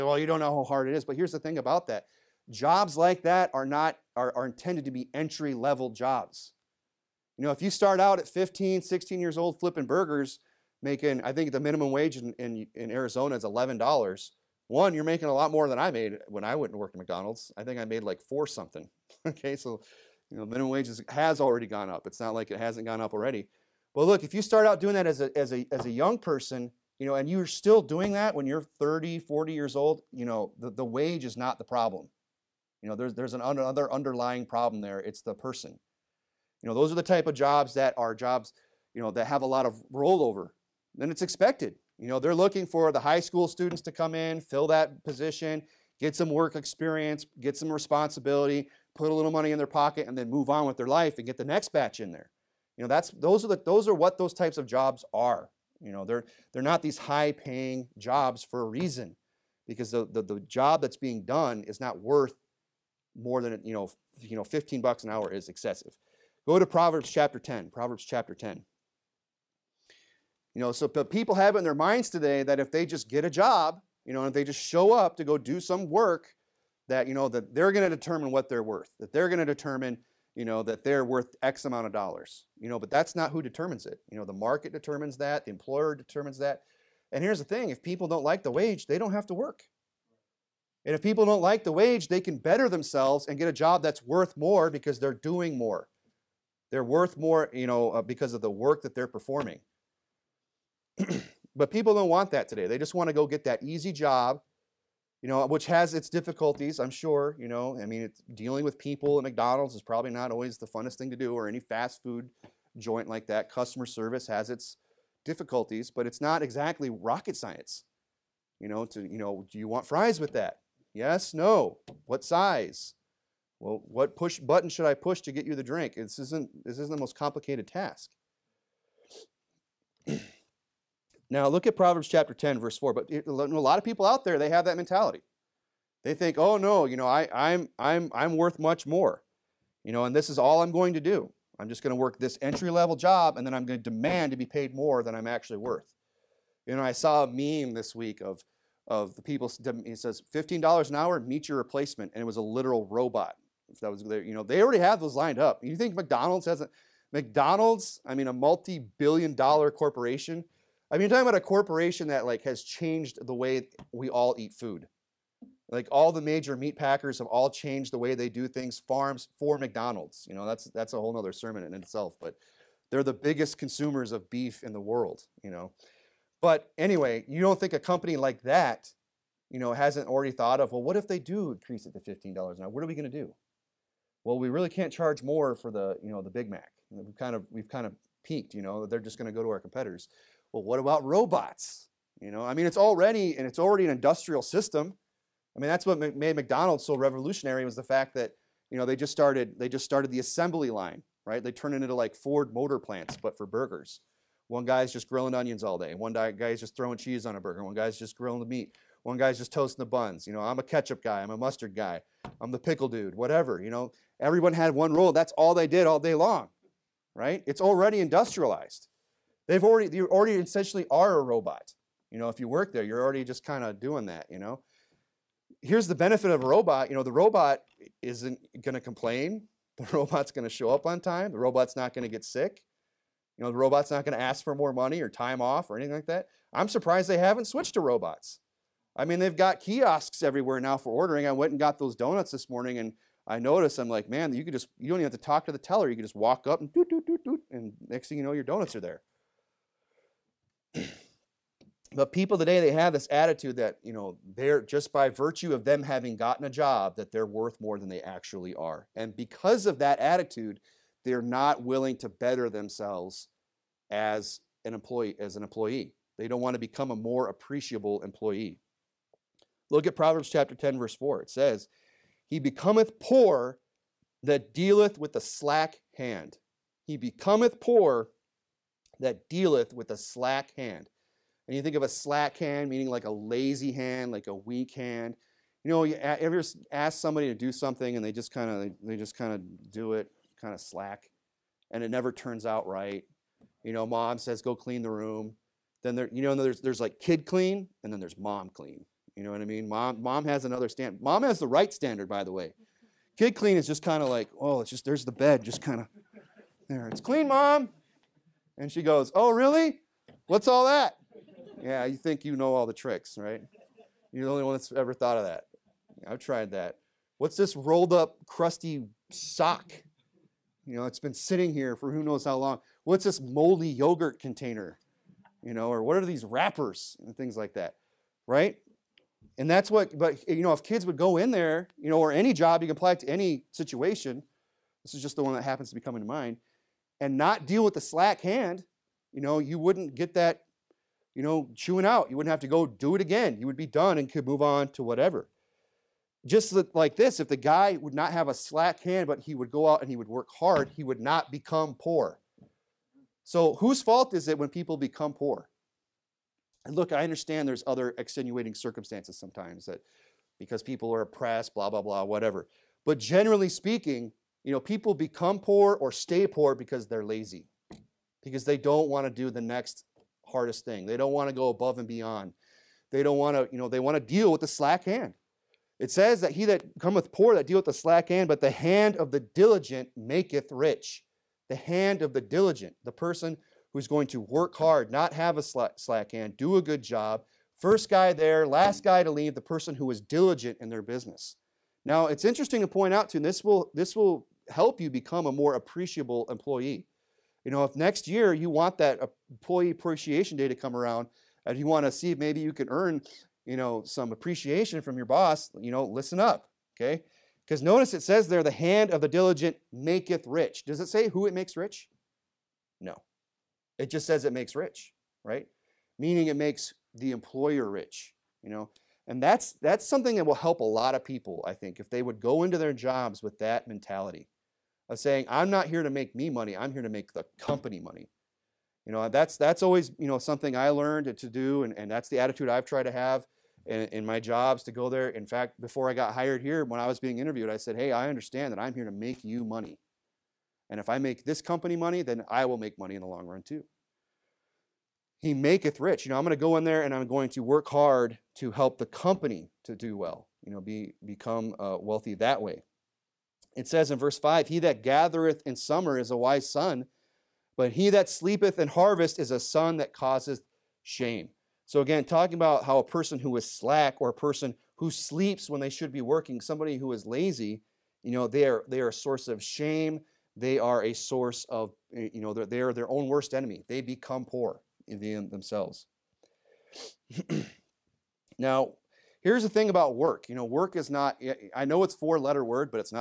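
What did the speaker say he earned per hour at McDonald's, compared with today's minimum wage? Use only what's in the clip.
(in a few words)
Four something.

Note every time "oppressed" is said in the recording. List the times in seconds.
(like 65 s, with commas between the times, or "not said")
361 s.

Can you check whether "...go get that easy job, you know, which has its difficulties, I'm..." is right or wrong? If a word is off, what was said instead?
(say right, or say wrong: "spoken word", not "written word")
right.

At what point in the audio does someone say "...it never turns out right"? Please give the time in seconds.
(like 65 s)
291 s.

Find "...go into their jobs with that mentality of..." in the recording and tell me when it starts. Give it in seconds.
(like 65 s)
422 s.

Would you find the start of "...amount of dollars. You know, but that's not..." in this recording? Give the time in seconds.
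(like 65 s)
81 s.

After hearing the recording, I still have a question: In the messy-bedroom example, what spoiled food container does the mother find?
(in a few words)
Moldy yogurt container.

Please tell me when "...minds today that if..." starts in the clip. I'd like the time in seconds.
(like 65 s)
71 s.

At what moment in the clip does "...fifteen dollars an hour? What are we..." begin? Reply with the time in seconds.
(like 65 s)
182 s.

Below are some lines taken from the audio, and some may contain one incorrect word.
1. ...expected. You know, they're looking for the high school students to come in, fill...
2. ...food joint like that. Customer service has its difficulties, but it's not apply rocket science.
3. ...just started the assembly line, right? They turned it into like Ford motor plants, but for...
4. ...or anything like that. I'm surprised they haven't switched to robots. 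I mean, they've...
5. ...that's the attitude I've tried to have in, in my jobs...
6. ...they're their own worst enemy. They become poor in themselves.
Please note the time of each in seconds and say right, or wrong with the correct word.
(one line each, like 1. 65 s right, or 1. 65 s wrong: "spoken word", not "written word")
1. 41 s right
2. 112 s wrong: "exactly", not "apply"
3. 199 s right
4. 235 s right
5. 431 s right
6. 472 s right.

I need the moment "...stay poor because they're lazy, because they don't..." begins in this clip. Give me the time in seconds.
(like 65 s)
365 s.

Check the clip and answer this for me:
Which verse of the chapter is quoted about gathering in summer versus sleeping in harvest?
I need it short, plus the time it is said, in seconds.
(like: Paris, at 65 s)
Verse 5, at 453 s.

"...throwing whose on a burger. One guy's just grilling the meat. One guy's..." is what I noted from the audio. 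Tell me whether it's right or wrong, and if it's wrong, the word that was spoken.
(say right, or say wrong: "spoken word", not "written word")
wrong: "cheese", not "whose".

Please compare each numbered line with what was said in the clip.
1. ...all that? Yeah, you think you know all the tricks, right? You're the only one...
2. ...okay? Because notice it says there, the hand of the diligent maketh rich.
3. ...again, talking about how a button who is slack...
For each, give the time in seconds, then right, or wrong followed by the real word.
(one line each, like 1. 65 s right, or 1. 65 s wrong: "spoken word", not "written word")
1. 310 s right
2. 406 s right
3. 461 s wrong: "person", not "button".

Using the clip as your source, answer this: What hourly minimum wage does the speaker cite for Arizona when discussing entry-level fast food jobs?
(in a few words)
$11.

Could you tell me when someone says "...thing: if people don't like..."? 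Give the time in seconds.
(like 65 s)
87 s.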